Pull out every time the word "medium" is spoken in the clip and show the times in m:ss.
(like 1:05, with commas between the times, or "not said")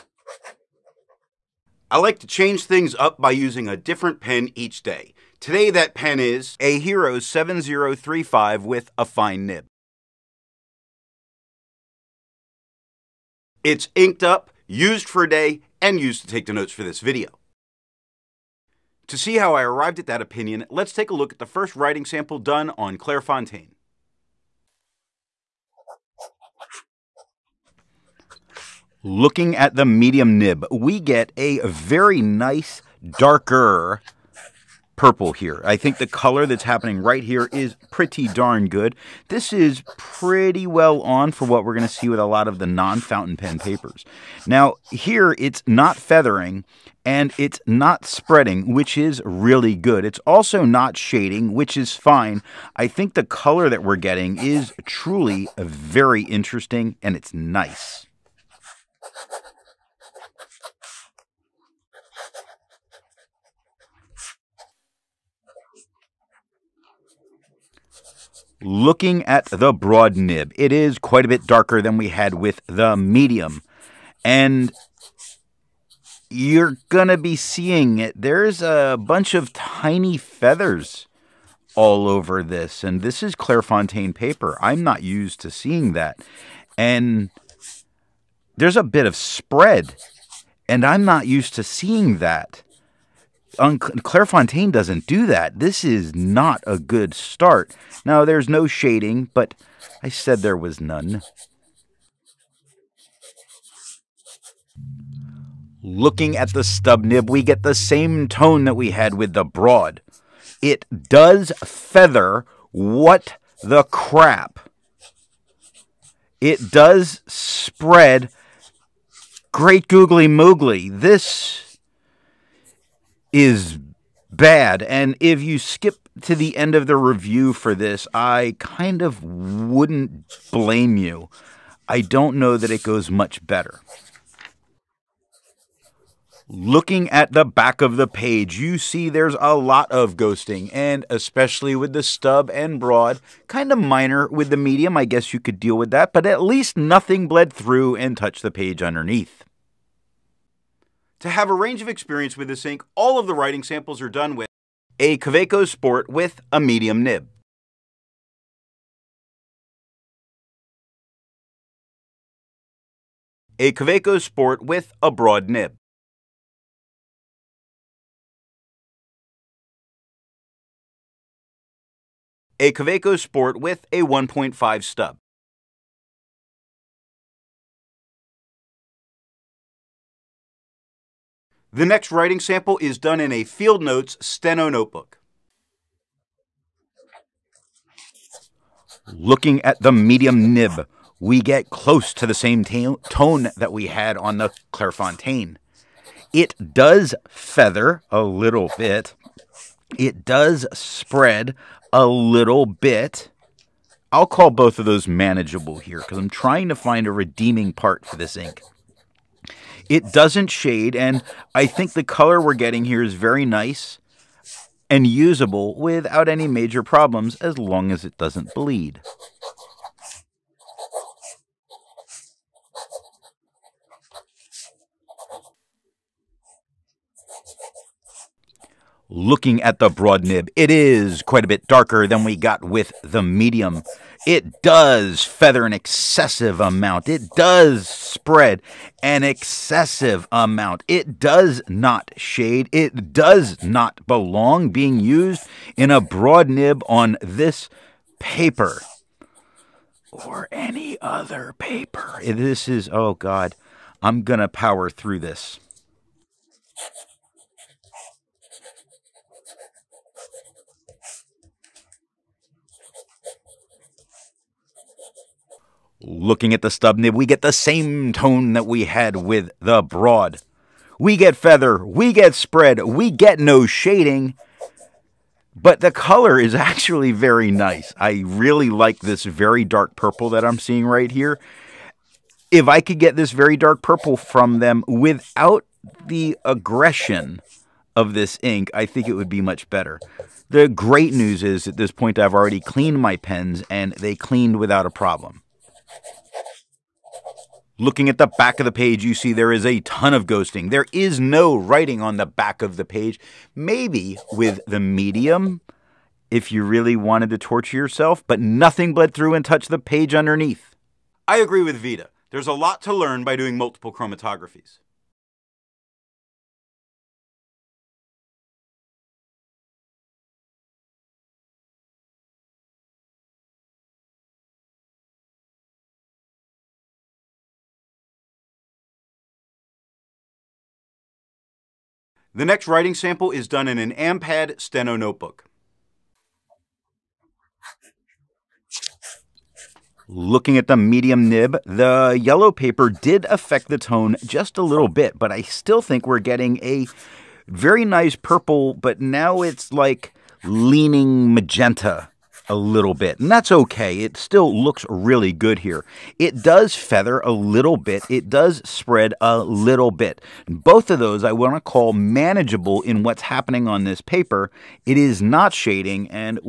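0:29, 1:12, 2:24, 2:36, 3:09, 3:53, 5:04, 5:40.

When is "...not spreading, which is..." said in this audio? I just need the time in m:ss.
0:47.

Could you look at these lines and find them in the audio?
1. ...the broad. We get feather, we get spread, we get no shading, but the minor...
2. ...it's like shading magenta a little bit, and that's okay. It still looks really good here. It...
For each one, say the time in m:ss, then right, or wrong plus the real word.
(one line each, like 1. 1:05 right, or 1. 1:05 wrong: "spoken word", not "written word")
1. 4:29 wrong: "color", not "minor"
2. 5:49 wrong: "leaning", not "shading".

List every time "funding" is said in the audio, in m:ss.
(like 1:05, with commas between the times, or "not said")
not said.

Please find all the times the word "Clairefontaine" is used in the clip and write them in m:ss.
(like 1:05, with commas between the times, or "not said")
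0:22, 1:23, 1:33, 3:14.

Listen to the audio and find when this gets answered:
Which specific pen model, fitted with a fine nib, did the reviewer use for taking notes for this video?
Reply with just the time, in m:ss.
0:06.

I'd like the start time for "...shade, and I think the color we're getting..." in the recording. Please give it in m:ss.
3:30.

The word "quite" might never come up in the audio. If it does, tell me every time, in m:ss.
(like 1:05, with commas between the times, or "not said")
1:10, 3:51.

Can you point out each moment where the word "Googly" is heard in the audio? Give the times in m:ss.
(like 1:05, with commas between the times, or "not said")
1:59.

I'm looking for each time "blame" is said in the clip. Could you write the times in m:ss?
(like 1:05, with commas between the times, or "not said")
2:10.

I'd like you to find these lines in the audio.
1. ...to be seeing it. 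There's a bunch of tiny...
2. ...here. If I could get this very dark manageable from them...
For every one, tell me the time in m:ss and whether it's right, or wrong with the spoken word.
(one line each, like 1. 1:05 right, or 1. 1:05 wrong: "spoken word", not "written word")
1. 1:17 right
2. 4:41 wrong: "purple", not "manageable".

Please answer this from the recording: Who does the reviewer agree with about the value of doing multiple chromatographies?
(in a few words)
Vita.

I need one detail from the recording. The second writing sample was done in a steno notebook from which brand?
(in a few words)
Field Notes.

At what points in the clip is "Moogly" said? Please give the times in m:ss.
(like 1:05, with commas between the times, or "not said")
2:00.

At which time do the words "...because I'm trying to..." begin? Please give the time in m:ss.
3:25.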